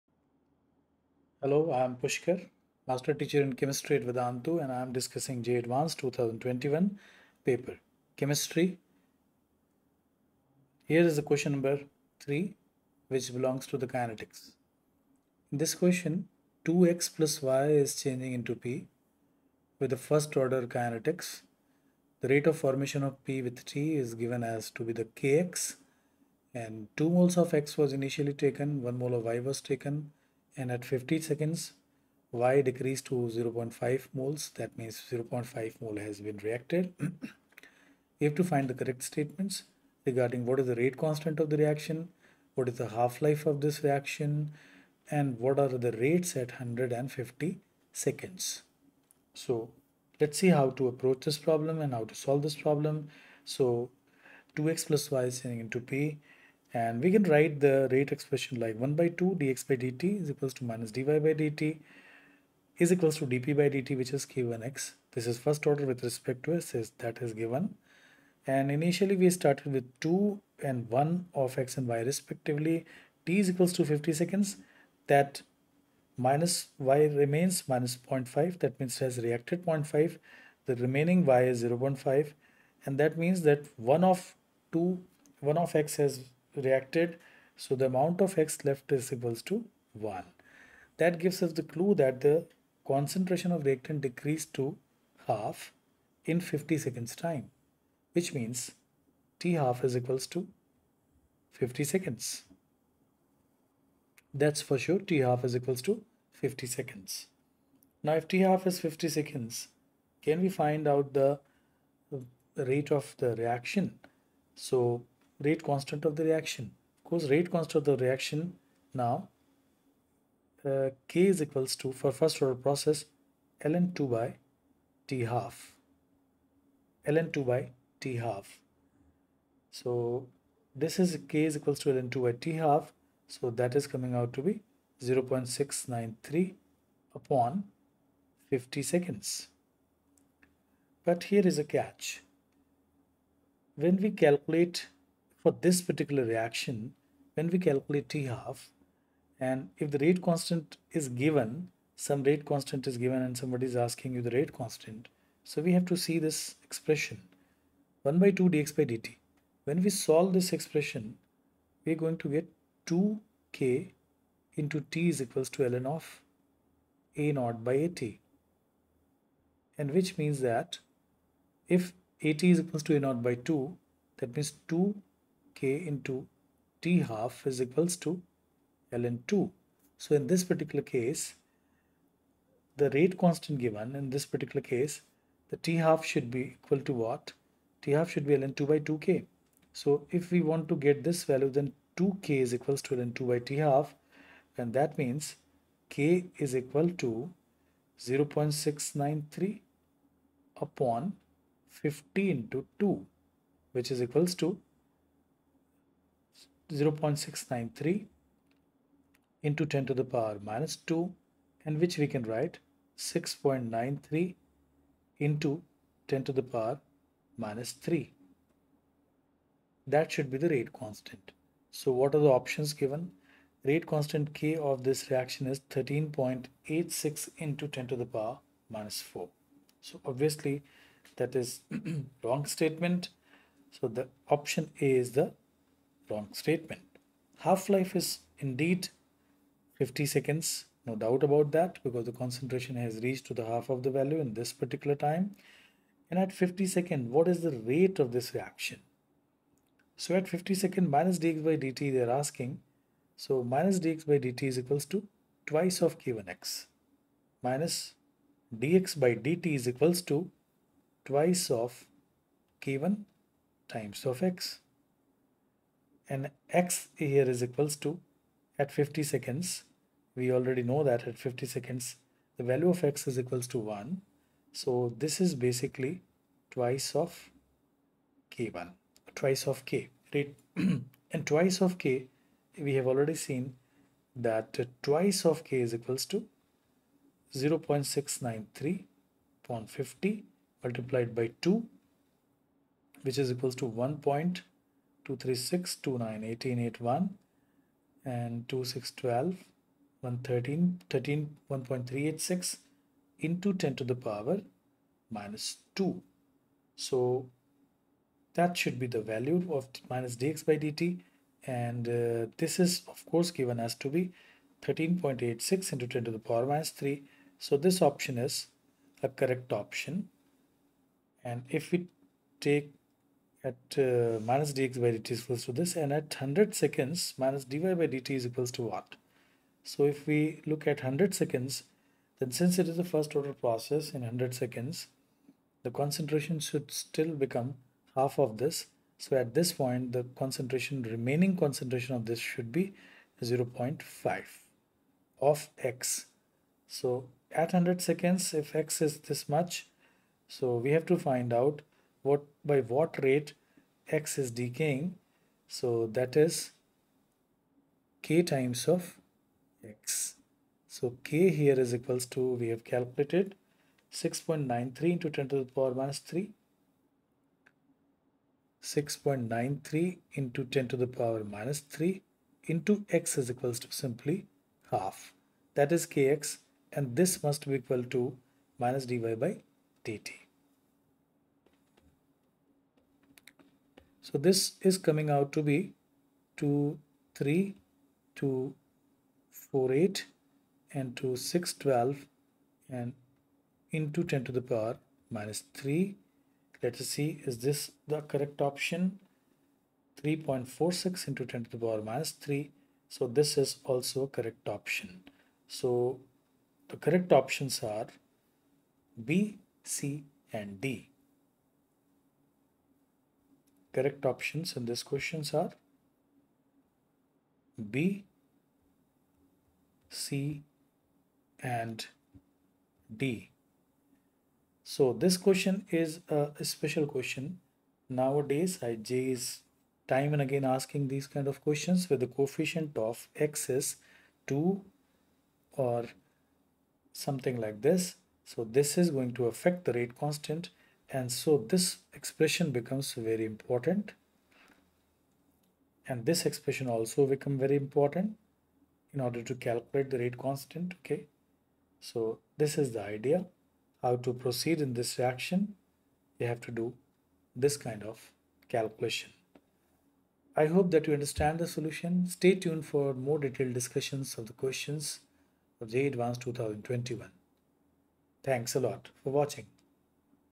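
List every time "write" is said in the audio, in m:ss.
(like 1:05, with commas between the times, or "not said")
0:57, 3:32.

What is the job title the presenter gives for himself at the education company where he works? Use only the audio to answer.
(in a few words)
Master Teacher in Chemistry.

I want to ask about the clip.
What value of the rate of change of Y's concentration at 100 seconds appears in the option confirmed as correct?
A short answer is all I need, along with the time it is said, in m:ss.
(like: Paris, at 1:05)
3.46 x 10^-3, at 6:40.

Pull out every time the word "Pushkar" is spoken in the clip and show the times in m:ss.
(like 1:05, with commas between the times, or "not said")
0:01.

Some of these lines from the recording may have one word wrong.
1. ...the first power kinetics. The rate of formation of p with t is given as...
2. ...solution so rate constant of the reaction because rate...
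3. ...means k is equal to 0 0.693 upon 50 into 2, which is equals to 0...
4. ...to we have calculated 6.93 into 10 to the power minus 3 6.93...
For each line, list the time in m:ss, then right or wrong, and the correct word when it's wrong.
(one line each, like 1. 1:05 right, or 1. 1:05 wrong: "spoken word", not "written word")
1. 0:19 wrong: "order", not "power"
2. 1:53 wrong: "reaction", not "solution"
3. 3:14 right
4. 6:02 right.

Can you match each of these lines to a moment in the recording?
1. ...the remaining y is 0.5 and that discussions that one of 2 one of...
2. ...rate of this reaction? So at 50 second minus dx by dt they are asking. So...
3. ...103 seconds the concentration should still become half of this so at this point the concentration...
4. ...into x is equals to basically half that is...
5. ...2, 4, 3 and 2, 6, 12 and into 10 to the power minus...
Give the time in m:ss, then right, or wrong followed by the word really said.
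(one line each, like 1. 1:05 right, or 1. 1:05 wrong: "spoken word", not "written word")
1. 1:20 wrong: "means", not "discussions"
2. 4:07 right
3. 5:34 wrong: "100", not "103"
4. 6:12 wrong: "simply", not "basically"
5. 6:28 wrong: "8", not "3".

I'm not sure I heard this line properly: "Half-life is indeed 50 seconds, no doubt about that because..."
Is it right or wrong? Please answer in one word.
right.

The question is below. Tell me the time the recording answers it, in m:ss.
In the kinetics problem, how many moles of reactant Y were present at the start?
0:28.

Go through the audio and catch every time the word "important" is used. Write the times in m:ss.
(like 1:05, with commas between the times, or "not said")
7:23, 7:27.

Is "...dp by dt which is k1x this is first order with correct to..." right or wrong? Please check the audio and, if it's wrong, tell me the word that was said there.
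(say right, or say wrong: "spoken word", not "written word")
wrong: "respect", not "correct".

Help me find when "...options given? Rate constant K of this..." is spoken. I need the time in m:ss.
3:42.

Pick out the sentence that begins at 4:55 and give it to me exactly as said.
236, 29, 18, 81, and 2612, 113, 13, 1.386 into 10 to the power minus 2.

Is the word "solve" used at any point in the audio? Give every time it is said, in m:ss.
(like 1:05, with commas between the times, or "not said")
0:52, 2:39.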